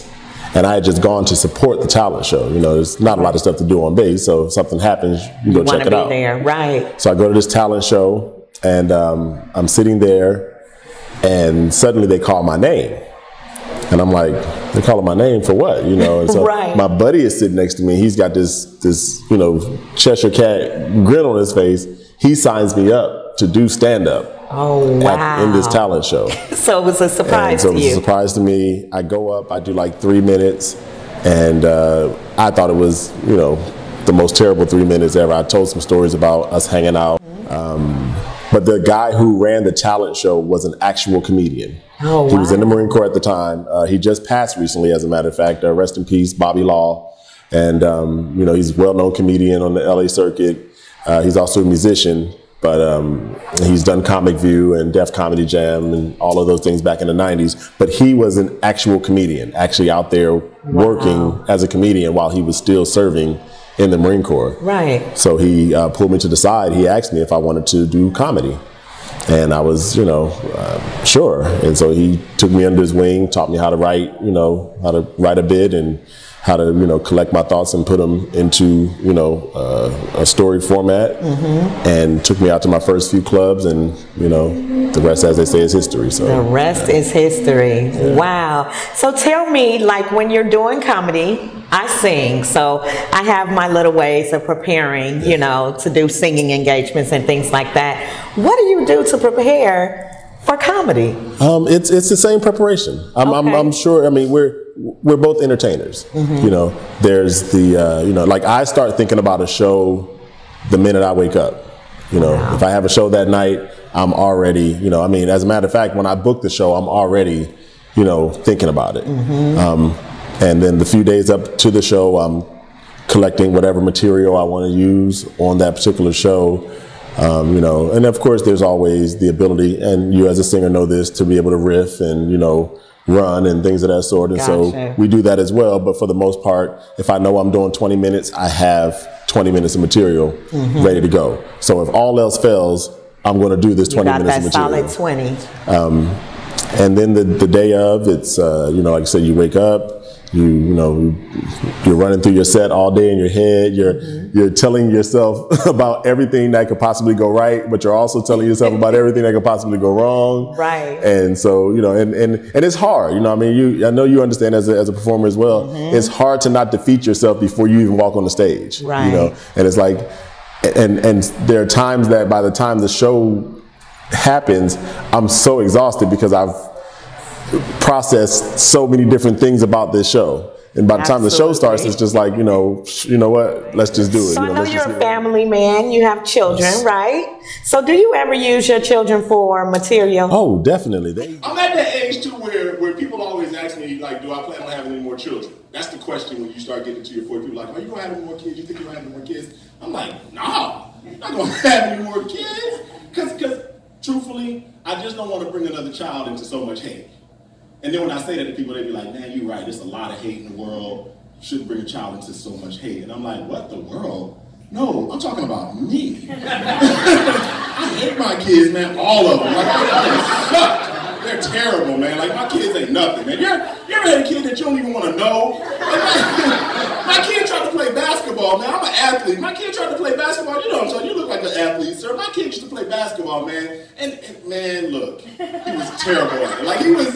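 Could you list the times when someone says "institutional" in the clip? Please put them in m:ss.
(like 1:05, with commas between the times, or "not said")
not said.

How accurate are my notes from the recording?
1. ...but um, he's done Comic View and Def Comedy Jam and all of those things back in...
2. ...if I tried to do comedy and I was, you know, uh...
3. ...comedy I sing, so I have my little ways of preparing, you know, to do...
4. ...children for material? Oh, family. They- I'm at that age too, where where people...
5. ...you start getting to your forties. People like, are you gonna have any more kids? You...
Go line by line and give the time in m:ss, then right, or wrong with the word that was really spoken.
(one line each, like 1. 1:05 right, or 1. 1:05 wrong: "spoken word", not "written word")
1. 0:52 right
2. 1:07 wrong: "wanted", not "tried"
3. 1:30 right
4. 3:08 wrong: "definitely", not "family"
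5. 3:16 right.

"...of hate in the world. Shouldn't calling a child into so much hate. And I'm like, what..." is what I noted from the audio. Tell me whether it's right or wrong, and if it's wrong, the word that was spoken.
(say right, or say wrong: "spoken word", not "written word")
wrong: "bring", not "calling".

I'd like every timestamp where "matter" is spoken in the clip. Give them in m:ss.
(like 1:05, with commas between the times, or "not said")
0:45, 1:55.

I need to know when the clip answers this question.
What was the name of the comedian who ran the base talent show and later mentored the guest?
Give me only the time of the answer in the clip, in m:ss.
0:46.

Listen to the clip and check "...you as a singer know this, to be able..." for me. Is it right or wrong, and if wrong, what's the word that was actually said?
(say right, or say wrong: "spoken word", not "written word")
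right.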